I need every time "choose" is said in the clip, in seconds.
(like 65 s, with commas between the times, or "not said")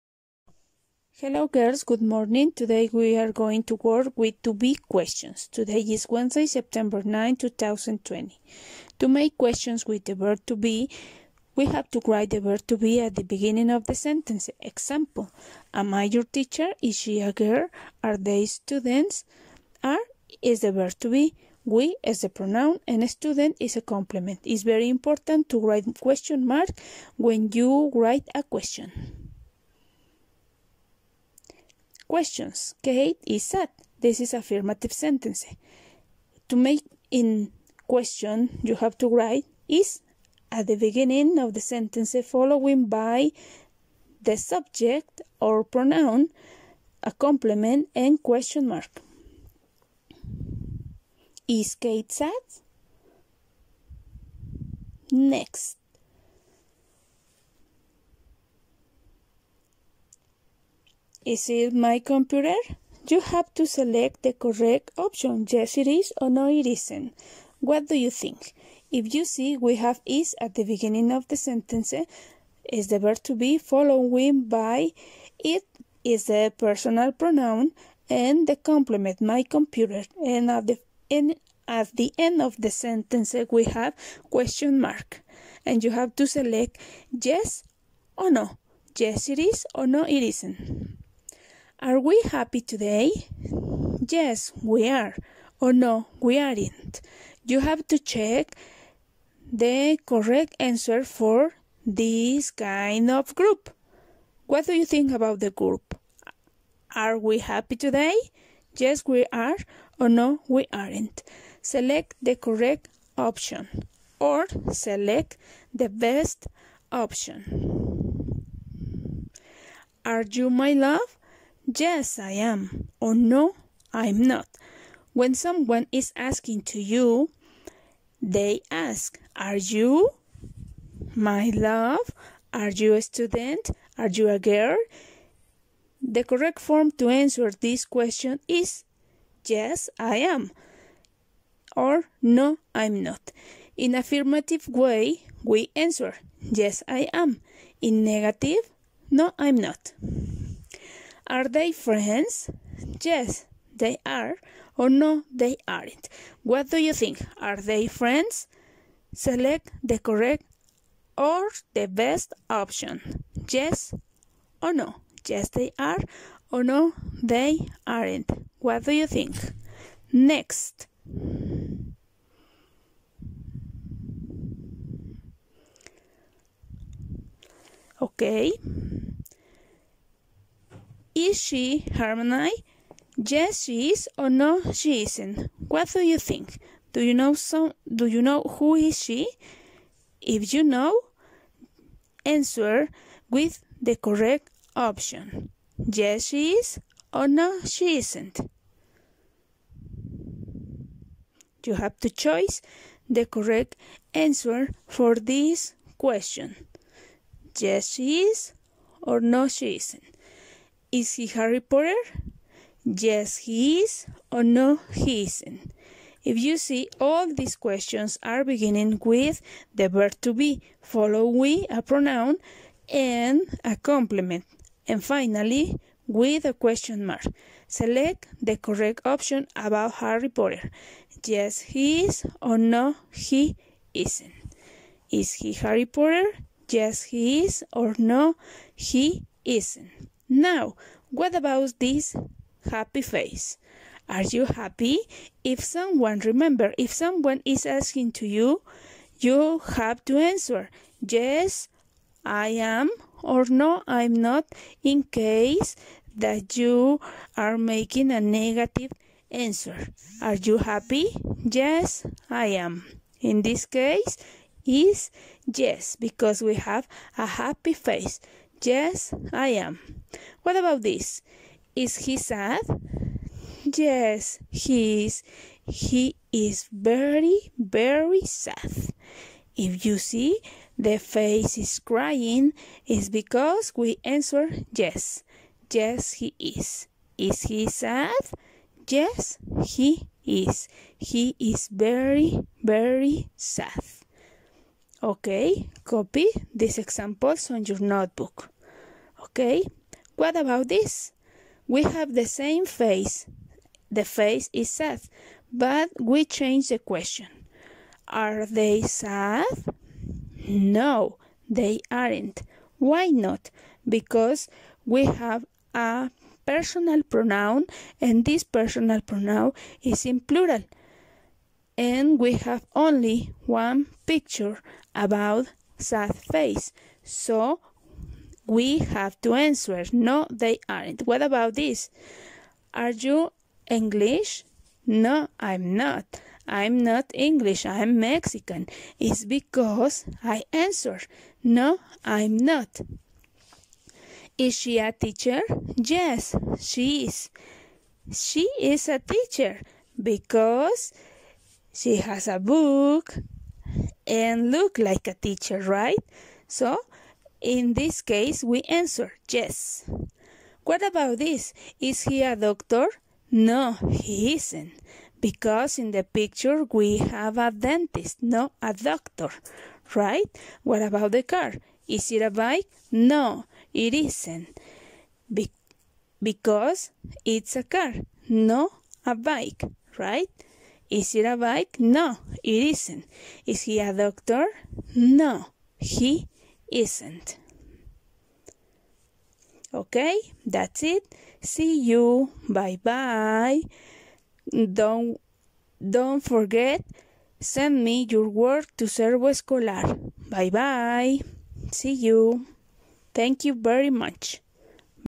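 202 s.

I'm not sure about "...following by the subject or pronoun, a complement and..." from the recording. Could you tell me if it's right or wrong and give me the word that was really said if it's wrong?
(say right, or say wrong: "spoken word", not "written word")
right.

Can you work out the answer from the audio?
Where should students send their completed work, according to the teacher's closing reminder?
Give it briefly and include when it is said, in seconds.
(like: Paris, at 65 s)
Servo Escolar, at 398 s.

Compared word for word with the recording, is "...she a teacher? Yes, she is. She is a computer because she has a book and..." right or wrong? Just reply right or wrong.
wrong.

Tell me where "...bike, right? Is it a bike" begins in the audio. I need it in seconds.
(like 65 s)
379 s.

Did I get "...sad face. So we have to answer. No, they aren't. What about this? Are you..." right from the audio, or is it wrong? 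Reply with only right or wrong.
right.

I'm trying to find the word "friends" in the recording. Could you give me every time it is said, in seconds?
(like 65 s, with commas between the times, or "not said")
151 s, 157 s.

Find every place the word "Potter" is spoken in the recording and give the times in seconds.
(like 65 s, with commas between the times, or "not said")
211 s, 230 s, 235 s.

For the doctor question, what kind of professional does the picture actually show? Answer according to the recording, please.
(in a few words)
A dentist.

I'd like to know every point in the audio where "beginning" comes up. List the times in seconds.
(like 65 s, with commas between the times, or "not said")
13 s, 40 s, 70 s, 218 s.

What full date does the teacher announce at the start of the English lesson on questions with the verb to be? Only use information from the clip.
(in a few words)
Wednesday, September 9, 2020.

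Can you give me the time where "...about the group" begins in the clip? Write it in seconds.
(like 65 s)
105 s.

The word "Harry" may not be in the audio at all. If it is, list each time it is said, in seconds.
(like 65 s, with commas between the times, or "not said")
211 s, 229 s, 235 s.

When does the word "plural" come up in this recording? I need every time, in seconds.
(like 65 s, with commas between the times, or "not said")
320 s.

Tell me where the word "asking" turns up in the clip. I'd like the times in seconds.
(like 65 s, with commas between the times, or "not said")
126 s, 247 s.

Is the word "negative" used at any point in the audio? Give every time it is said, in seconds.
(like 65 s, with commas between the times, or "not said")
148 s, 258 s.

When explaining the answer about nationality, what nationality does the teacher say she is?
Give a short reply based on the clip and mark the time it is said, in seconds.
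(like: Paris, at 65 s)
Mexican, at 337 s.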